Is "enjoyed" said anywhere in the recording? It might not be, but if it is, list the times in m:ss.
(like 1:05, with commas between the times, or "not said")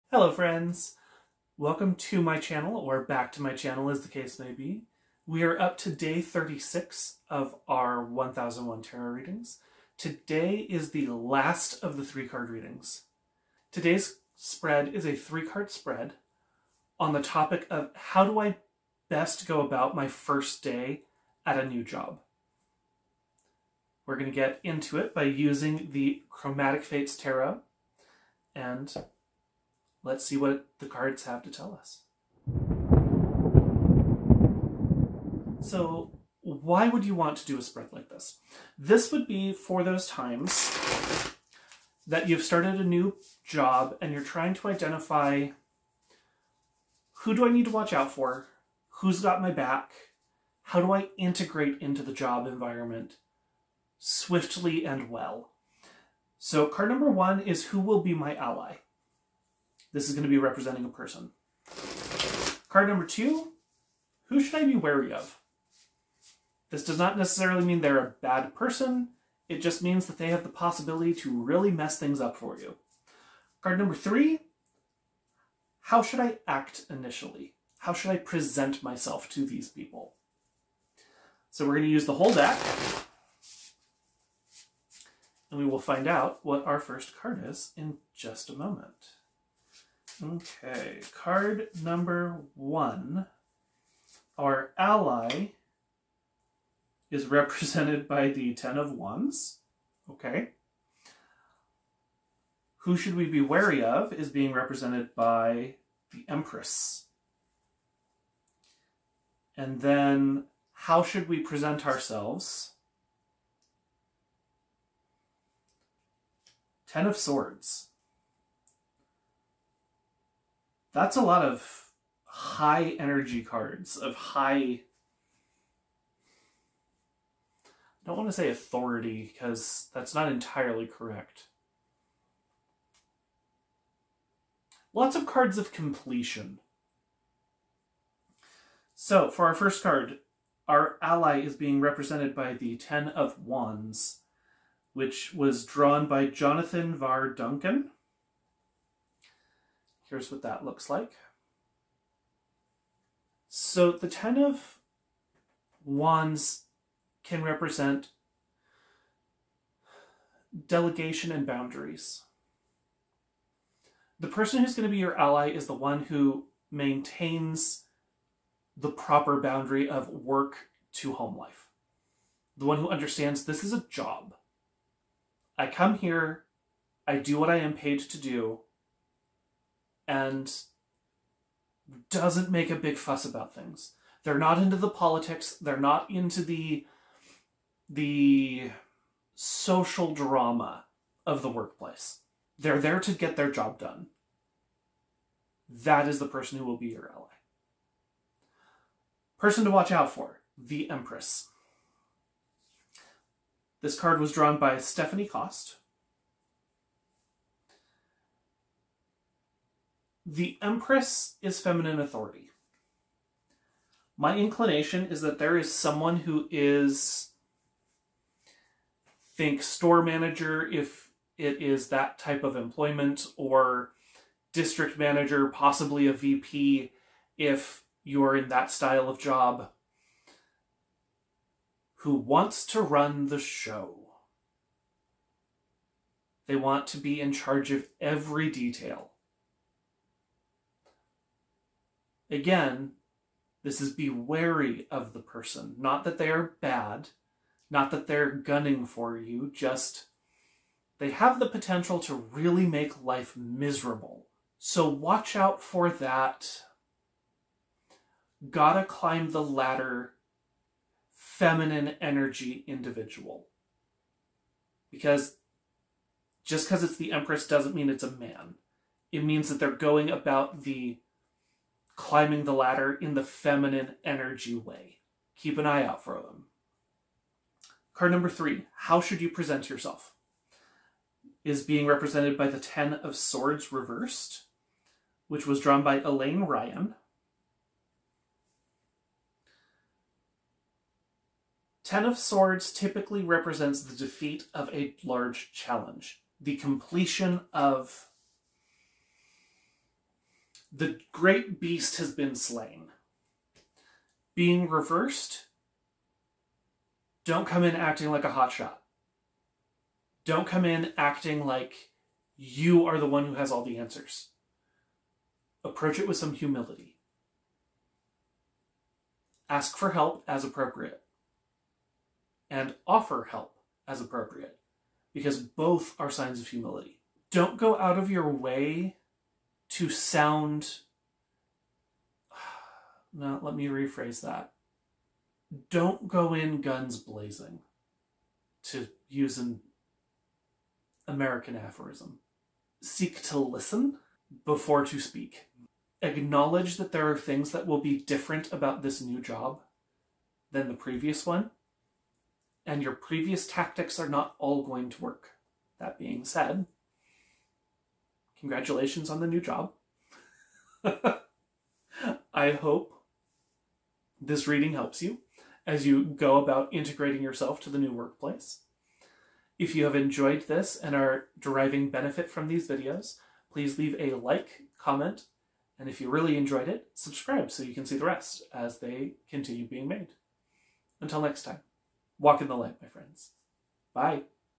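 6:09, 6:16.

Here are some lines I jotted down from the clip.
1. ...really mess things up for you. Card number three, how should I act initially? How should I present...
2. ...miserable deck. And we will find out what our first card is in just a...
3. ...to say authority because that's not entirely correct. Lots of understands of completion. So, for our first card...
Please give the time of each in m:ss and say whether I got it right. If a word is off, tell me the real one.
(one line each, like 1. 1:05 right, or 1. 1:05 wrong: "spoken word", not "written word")
1. 1:11 right
2. 1:22 wrong: "whole", not "miserable"
3. 2:08 wrong: "cards", not "understands".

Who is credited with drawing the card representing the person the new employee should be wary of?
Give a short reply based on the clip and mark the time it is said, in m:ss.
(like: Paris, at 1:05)
Stephanie Cost, at 3:24.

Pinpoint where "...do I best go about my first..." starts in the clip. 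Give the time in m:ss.
0:18.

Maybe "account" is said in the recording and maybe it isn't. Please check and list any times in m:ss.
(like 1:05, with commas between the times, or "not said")
not said.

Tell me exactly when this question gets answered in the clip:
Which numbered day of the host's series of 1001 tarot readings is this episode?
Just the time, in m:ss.
0:05.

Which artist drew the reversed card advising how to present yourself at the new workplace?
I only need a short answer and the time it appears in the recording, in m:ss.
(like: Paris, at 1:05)
Elaine Ryan, at 4:46.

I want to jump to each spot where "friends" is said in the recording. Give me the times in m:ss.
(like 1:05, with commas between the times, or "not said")
0:00, 6:22.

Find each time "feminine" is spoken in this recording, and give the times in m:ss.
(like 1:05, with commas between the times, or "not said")
3:31, 4:21, 4:33.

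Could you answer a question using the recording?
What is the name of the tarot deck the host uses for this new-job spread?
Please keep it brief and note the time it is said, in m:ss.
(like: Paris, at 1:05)
Chromatic Fates Tarot, at 0:26.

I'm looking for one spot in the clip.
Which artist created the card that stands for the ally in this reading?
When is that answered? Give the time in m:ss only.
2:26.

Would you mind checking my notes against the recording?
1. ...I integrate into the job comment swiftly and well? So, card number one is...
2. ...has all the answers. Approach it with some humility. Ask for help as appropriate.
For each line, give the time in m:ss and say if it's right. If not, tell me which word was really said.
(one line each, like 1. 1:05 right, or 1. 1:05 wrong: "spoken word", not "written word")
1. 0:50 wrong: "environment", not "comment"
2. 5:13 right.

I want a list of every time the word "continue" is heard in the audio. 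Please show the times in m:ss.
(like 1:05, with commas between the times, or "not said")
6:19.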